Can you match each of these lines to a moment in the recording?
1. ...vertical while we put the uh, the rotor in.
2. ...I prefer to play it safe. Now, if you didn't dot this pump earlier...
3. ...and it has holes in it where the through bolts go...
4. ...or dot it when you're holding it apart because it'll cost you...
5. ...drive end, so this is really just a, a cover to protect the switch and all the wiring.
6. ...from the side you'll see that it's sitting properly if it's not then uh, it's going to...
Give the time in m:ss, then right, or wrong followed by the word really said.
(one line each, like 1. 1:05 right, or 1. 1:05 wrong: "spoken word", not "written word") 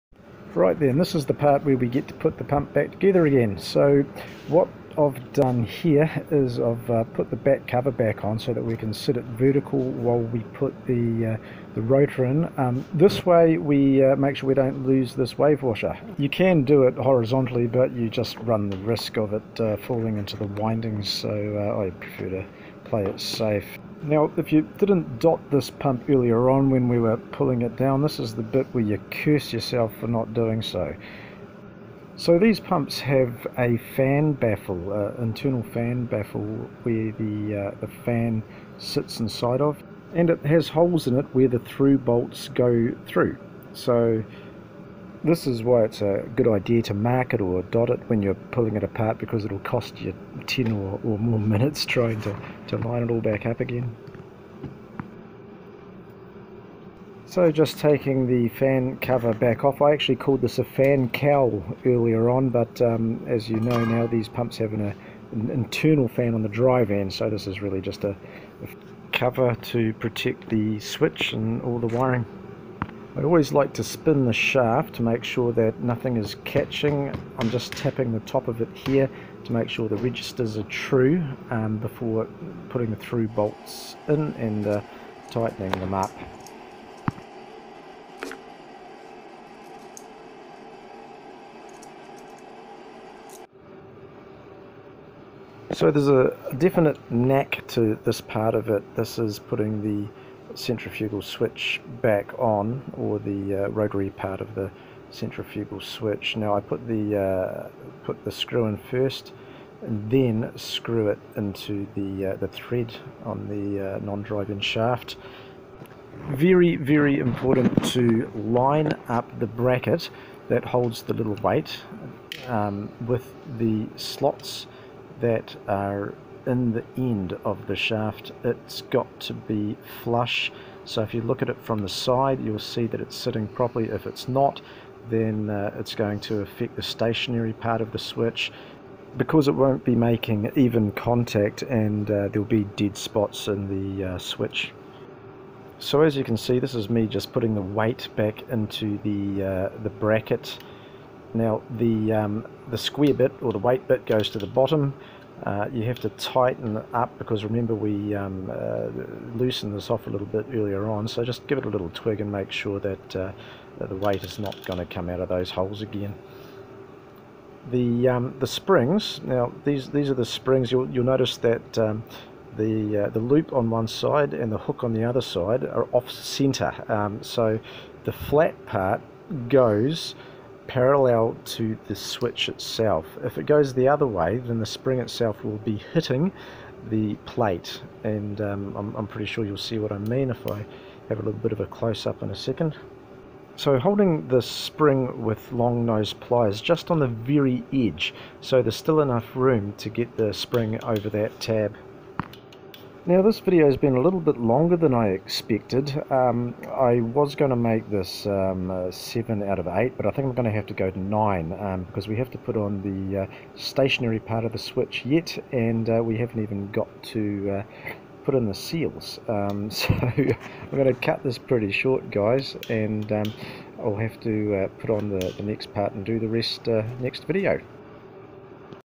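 1. 0:09 right
2. 0:21 right
3. 0:40 right
4. 0:47 wrong: "pulling", not "holding"
5. 1:06 right
6. 2:11 right.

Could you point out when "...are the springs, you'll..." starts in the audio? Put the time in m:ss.
2:50.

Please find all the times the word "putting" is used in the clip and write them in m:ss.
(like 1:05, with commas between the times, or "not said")
1:22, 1:39, 2:27.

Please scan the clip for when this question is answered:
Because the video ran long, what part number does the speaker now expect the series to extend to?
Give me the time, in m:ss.
3:30.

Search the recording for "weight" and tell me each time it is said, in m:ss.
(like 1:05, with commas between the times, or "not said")
2:01, 2:27, 2:33, 2:43.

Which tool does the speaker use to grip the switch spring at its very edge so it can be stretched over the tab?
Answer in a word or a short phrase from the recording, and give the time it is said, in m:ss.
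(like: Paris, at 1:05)
long nose pliers, at 3:15.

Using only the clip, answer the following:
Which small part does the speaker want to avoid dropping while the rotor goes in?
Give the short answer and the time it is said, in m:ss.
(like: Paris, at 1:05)
wave washer, at 0:15.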